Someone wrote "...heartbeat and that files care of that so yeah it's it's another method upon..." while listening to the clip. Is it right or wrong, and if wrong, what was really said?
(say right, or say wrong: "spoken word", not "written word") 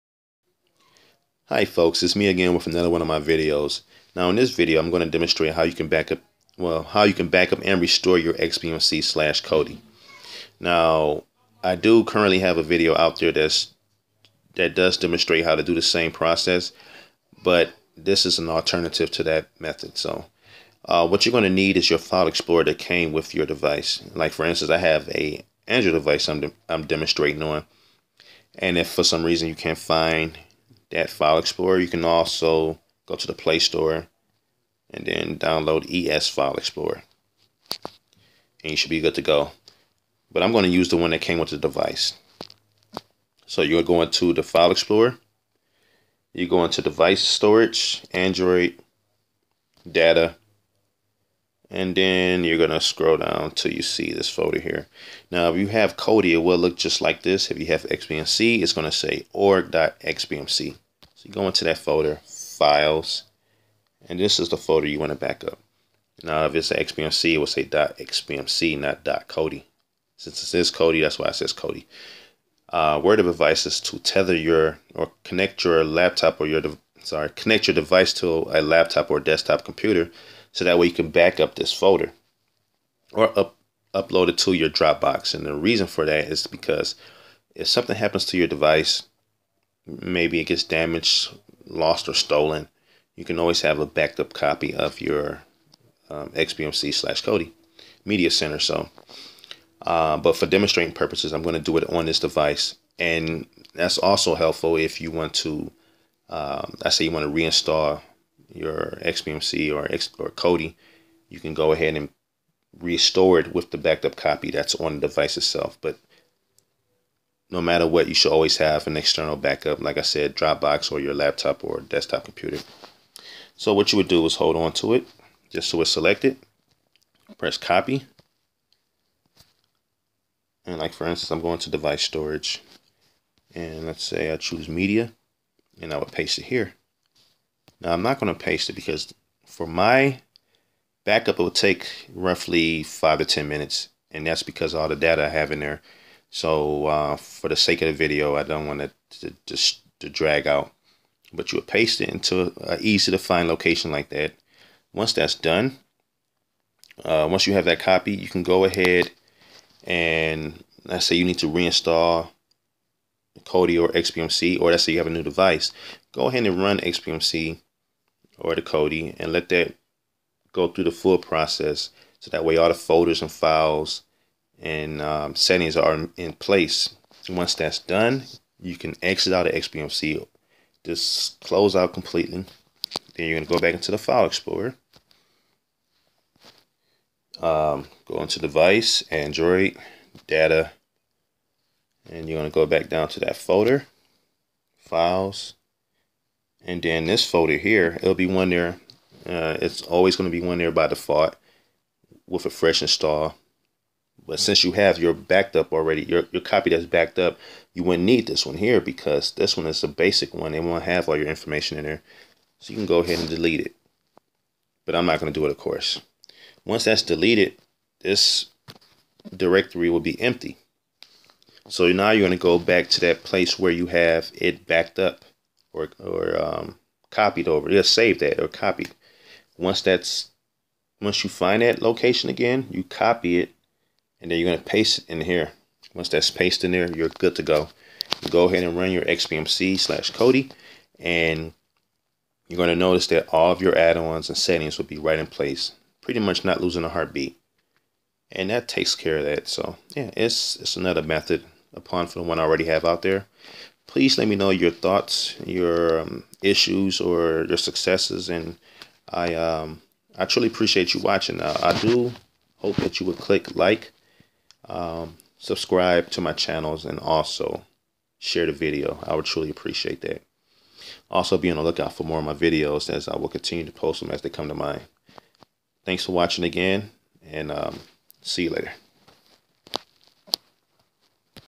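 wrong: "takes", not "files".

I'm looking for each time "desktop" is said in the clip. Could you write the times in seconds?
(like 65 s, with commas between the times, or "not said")
79 s, 121 s.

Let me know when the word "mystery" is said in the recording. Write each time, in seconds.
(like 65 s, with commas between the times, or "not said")
not said.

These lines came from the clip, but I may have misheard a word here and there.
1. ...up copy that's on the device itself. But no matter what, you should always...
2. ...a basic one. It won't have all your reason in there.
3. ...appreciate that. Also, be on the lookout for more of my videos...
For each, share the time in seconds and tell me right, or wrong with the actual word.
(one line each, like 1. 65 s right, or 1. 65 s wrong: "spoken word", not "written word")
1. 114 s right
2. 209 s wrong: "information", not "reason"
3. 269 s right.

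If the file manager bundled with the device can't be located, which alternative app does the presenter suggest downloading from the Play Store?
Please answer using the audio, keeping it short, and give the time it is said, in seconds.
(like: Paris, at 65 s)
ES File Explorer, at 35 s.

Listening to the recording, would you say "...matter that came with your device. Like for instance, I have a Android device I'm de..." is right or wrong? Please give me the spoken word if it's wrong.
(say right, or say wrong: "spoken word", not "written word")
wrong: "explorer", not "matter".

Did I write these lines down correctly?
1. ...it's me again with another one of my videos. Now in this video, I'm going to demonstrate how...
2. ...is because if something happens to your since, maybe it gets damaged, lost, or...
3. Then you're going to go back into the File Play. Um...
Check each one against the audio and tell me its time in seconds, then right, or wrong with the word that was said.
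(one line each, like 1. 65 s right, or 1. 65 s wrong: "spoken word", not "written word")
1. 2 s right
2. 86 s wrong: "device", not "since"
3. 183 s wrong: "Explorer", not "Play".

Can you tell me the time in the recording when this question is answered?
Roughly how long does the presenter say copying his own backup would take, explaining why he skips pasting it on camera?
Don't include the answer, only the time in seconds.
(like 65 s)
142 s.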